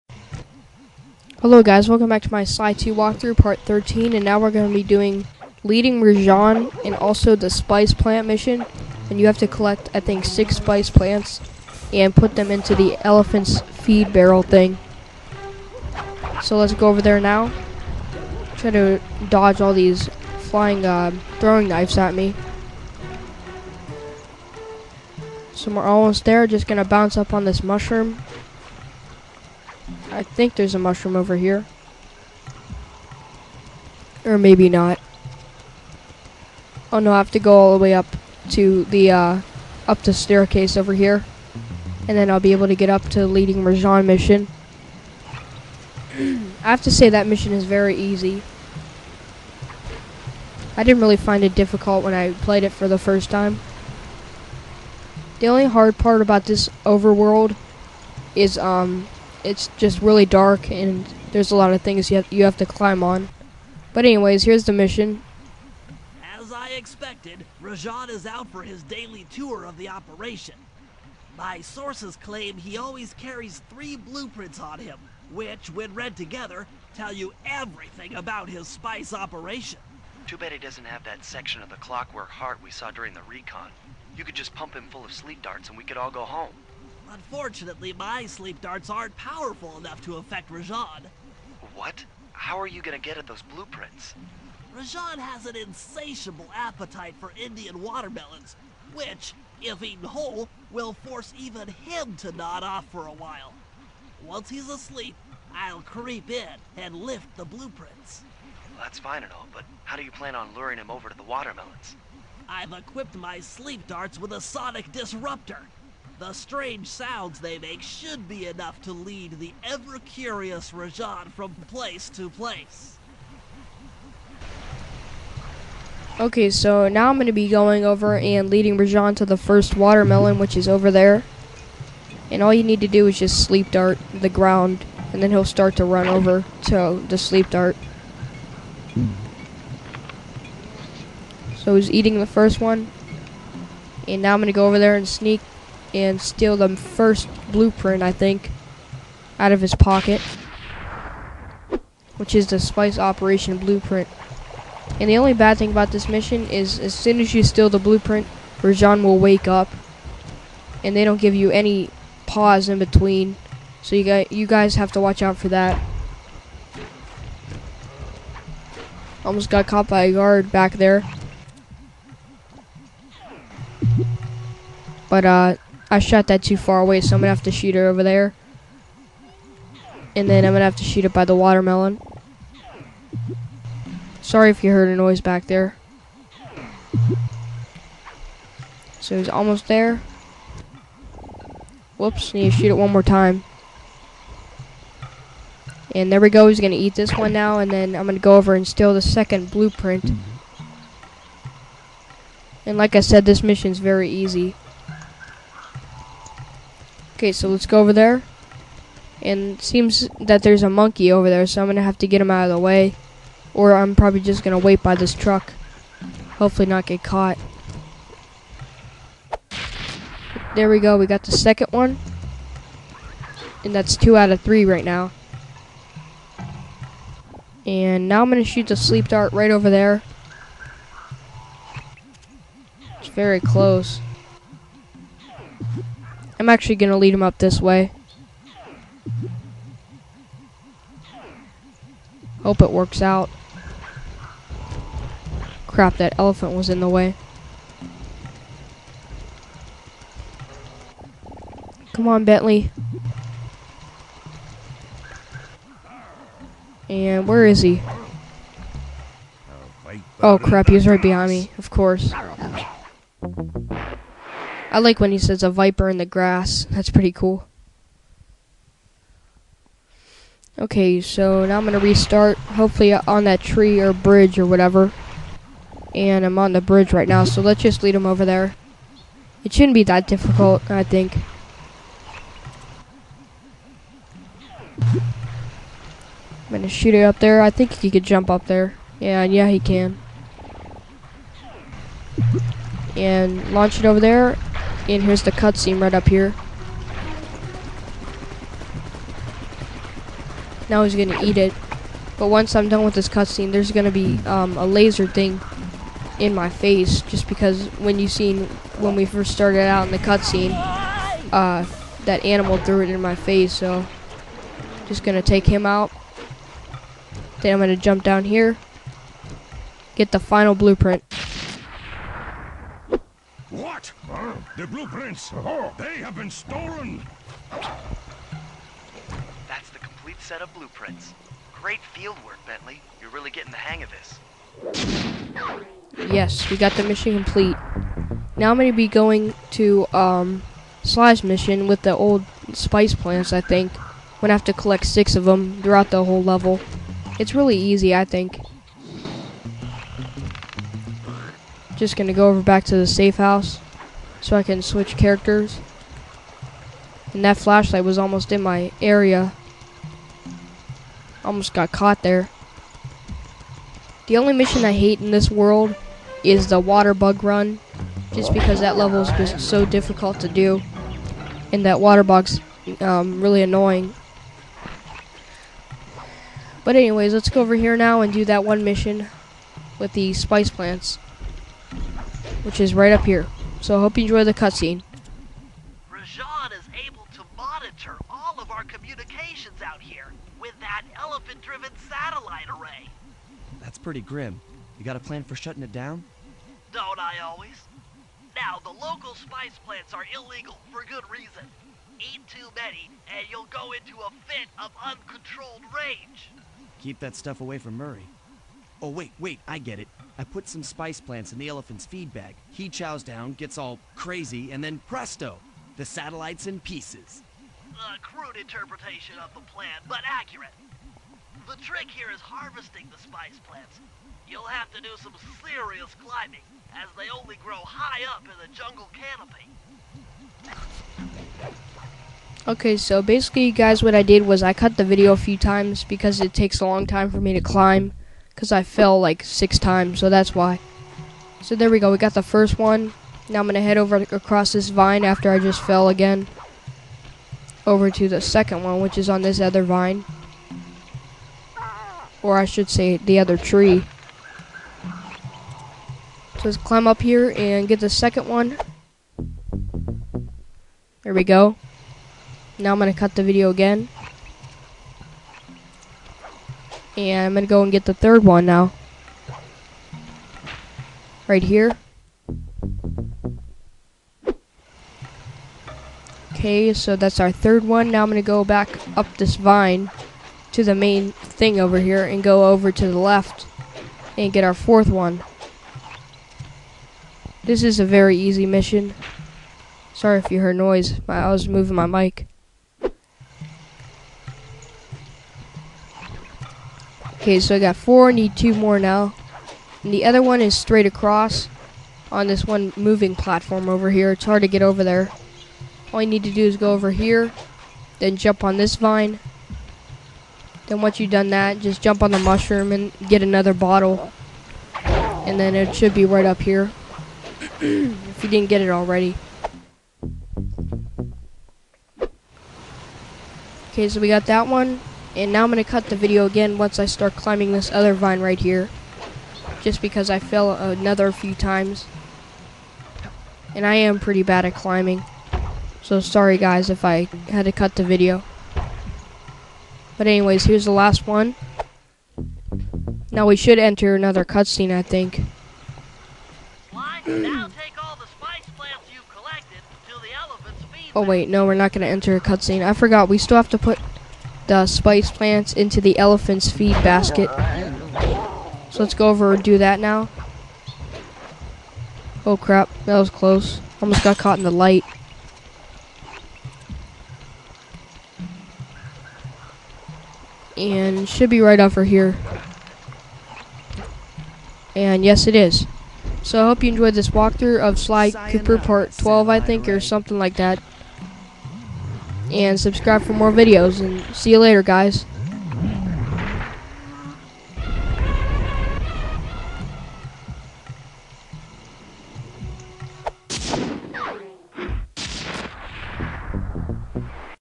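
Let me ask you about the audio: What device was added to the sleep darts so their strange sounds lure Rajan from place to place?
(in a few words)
sonic disruptor.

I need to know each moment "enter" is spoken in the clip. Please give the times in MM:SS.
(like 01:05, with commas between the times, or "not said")
09:03, 09:11.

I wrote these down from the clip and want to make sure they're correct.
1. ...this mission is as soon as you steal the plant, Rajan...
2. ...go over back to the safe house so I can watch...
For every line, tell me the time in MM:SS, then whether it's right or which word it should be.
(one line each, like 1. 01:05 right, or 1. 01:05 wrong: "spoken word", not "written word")
1. 02:35 wrong: "blueprint", not "plant"
2. 05:52 wrong: "switch", not "watch".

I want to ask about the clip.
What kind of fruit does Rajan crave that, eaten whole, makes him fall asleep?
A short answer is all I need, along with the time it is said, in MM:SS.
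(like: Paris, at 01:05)
Indian watermelons, at 01:37.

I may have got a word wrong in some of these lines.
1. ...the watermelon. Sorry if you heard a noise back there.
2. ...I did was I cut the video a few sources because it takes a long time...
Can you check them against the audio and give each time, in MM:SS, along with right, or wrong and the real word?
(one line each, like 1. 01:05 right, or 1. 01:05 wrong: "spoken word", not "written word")
1. 03:01 right
2. 07:13 wrong: "times", not "sources".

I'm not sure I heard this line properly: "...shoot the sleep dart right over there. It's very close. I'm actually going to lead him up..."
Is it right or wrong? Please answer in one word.
right.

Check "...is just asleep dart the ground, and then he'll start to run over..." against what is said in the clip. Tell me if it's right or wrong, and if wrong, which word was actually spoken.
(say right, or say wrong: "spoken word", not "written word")
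wrong: "sleep", not "asleep".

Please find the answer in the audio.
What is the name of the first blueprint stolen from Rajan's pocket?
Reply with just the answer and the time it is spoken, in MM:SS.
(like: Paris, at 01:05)
Spice Operation Blueprint, at 02:32.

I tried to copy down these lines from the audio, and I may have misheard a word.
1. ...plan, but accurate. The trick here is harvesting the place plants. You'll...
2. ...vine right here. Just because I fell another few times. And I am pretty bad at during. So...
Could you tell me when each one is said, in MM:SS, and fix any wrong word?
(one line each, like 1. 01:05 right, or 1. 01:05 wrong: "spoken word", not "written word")
1. 06:59 wrong: "spice", not "place"
2. 08:47 wrong: "climbing", not "during".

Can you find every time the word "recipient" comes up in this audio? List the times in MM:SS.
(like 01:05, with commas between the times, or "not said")
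not said.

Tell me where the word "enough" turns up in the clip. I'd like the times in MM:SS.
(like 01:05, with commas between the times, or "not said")
01:29, 01:58.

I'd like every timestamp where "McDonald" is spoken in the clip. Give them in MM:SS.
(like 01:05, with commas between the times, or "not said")
not said.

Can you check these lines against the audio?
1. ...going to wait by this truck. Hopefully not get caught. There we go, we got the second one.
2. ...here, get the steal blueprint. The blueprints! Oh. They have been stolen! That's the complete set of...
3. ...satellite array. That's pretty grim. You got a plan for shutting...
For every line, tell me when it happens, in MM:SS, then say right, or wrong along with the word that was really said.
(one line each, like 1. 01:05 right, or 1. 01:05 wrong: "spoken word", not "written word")
1. 03:34 right
2. 05:18 wrong: "final", not "steal"
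3. 06:31 right.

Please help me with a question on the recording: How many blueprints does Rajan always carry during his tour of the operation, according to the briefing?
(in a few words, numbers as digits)
3.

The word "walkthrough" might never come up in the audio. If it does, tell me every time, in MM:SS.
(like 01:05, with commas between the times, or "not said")
00:02, 09:37.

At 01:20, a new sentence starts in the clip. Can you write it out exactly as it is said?
Too bad he doesn't have that section of the clockwork heart we saw during the recon.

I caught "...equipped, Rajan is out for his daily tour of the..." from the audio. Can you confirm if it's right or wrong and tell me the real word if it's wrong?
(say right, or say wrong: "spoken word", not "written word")
wrong: "expected", not "equipped".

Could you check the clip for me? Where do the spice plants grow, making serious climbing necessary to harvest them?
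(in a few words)
jungle canopy.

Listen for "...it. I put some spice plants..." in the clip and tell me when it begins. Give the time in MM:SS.
06:49.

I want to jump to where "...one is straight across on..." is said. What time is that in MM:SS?
08:20.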